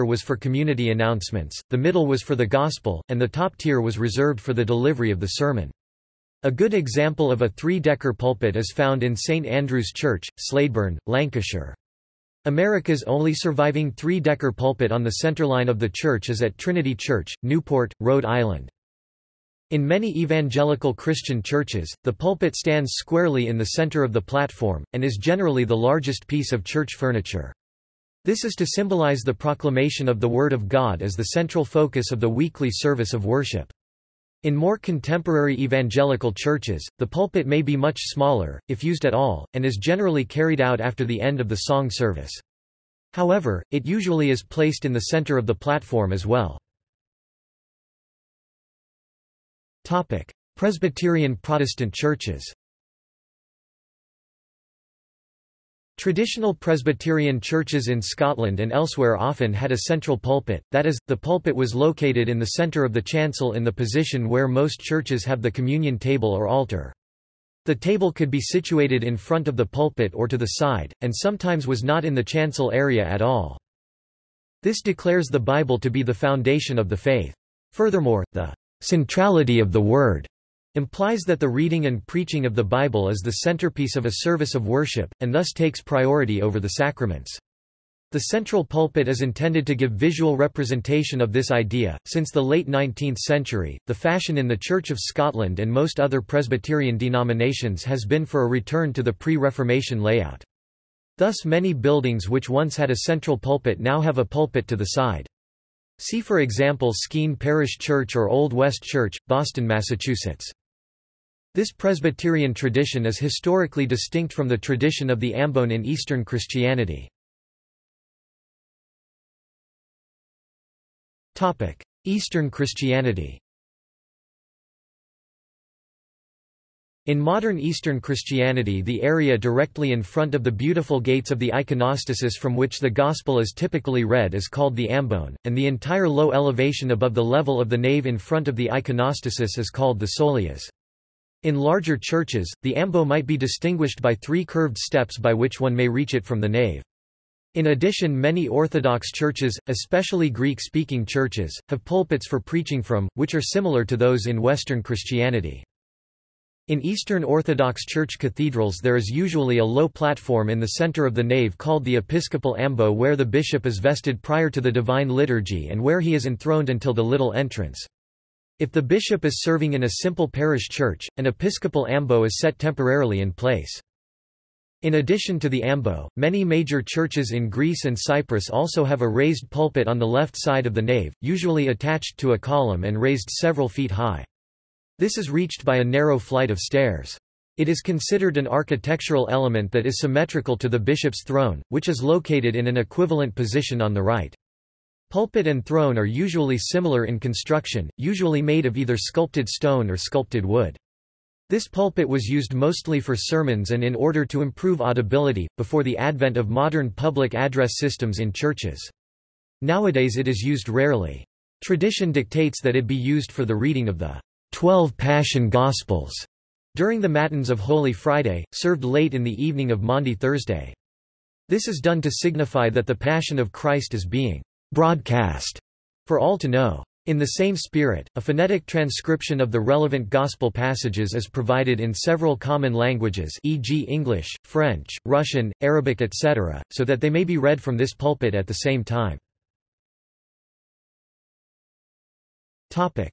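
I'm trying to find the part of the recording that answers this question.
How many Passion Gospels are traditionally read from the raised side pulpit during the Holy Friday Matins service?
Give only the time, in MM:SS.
03:34.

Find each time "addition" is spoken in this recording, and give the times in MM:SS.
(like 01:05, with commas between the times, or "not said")
02:27, 02:54.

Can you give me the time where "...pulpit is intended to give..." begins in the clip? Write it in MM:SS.
01:28.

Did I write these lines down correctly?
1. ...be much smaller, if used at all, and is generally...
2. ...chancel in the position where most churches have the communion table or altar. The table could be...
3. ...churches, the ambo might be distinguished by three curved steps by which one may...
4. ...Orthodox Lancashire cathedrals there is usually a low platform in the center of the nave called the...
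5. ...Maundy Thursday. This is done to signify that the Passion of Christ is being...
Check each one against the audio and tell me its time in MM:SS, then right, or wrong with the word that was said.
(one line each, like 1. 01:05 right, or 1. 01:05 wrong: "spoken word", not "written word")
1. 00:37 right
2. 01:03 right
3. 02:21 right
4. 02:37 wrong: "Church", not "Lancashire"
5. 03:39 right.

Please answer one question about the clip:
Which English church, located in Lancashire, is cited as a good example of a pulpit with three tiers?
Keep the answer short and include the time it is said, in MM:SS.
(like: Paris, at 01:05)
St Andrew's Church, Slaidburn, at 00:09.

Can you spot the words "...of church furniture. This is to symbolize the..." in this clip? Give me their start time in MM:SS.
00:26.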